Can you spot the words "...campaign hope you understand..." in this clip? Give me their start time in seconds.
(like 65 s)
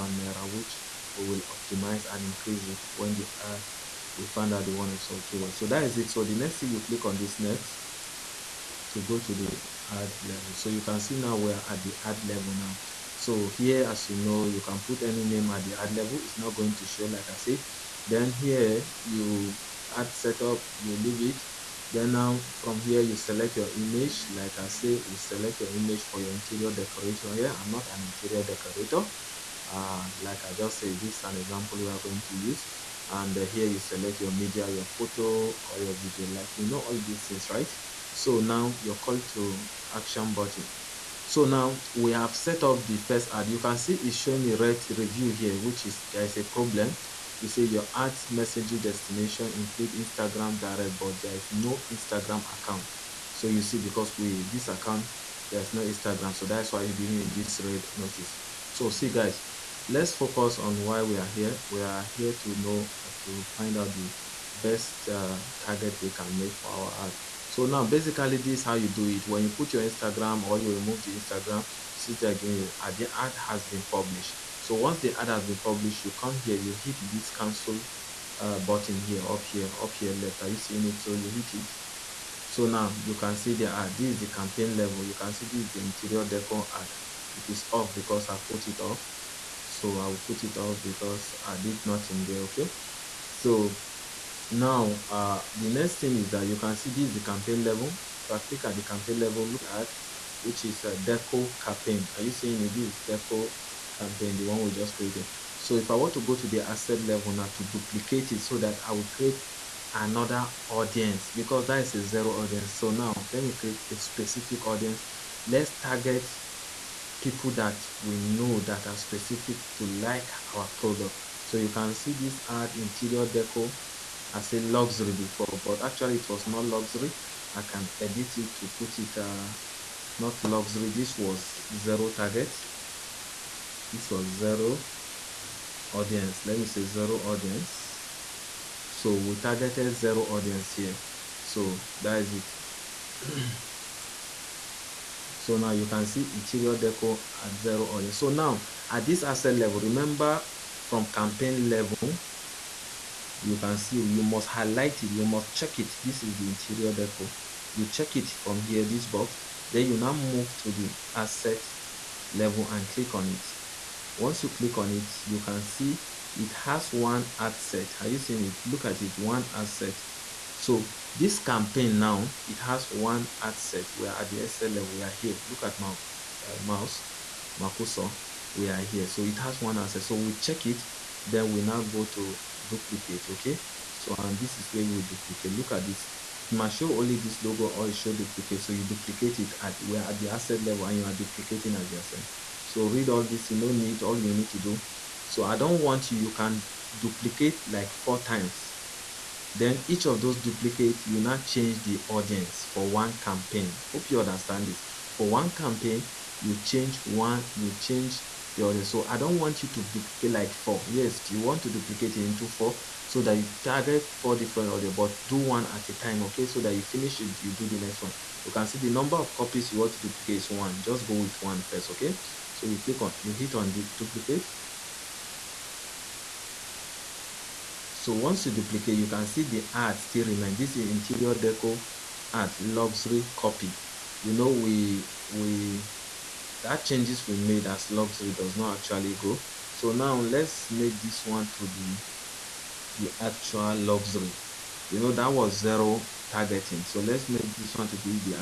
203 s.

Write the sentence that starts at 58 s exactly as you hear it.
So see guys, let's focus on why we are here.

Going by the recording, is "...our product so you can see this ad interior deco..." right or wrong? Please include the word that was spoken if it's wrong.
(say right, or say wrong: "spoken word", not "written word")
right.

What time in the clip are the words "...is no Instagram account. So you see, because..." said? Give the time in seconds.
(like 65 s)
51 s.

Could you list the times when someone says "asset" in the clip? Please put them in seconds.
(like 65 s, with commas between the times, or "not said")
149 s.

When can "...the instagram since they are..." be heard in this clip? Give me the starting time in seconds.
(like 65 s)
71 s.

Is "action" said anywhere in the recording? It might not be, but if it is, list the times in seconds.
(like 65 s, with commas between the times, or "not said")
39 s.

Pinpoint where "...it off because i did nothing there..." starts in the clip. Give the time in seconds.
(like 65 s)
90 s.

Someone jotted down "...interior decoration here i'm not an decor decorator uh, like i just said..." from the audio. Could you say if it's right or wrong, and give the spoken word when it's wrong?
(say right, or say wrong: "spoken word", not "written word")
wrong: "interior", not "decor".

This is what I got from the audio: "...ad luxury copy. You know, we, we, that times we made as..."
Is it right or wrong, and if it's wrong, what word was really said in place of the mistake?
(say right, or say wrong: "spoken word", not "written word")
wrong: "changes", not "times".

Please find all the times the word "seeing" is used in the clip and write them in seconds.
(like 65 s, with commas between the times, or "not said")
80 s, 102 s, 168 s.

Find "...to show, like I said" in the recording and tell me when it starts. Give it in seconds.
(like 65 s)
16 s.